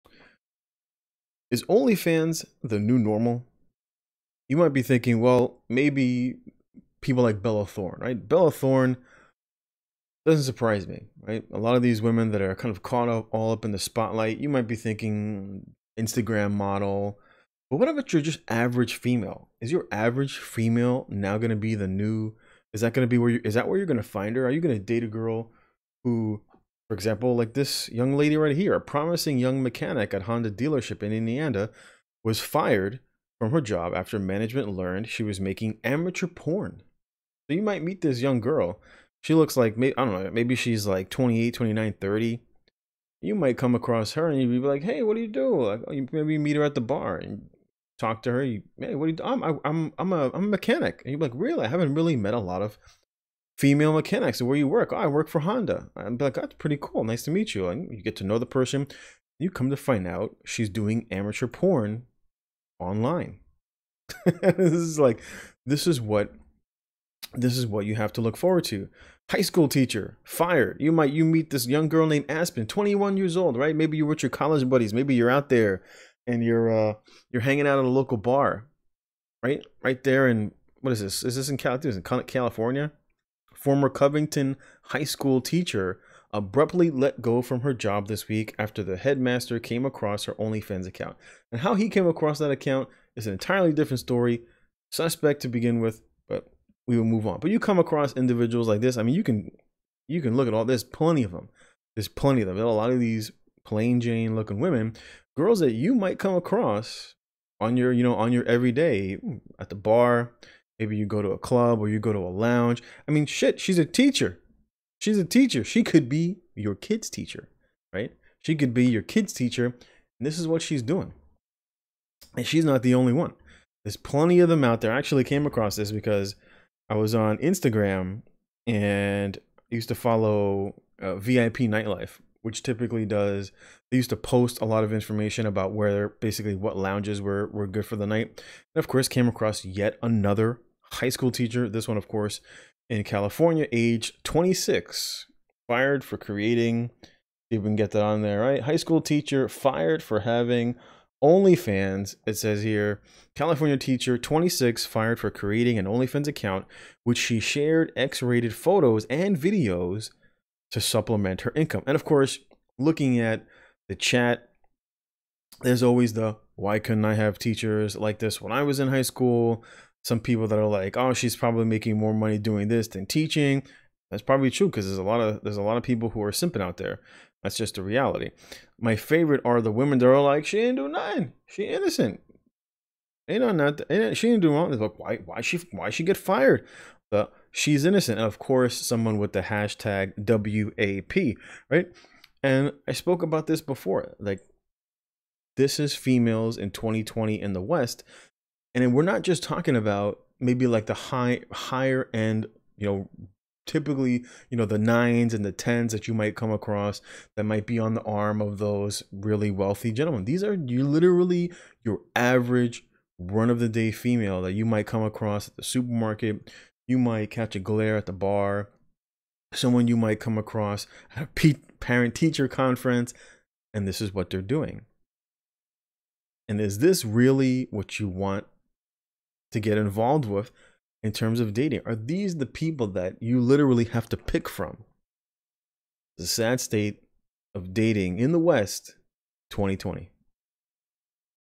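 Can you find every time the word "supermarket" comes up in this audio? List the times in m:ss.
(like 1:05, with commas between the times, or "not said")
3:35.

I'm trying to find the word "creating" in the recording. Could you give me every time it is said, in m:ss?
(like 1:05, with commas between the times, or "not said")
2:26, 2:35.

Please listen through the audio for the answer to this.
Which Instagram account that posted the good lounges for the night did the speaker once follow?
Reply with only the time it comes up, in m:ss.
2:11.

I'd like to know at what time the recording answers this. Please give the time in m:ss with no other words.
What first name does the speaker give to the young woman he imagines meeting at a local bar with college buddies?
1:12.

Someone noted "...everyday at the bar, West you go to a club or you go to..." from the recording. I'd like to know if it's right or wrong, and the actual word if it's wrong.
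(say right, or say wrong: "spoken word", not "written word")
wrong: "Maybe", not "West".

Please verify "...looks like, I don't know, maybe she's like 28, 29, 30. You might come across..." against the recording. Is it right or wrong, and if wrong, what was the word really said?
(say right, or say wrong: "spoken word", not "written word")
right.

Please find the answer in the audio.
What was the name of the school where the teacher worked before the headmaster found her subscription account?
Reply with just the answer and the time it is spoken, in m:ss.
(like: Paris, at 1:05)
Covington High School, at 1:23.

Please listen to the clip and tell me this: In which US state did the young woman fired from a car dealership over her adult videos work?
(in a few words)
Indiana.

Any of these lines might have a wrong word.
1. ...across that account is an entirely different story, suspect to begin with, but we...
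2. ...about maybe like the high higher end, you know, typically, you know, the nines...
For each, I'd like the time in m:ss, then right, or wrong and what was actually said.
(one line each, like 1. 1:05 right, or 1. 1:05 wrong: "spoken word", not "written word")
1. 1:32 right
2. 3:19 right.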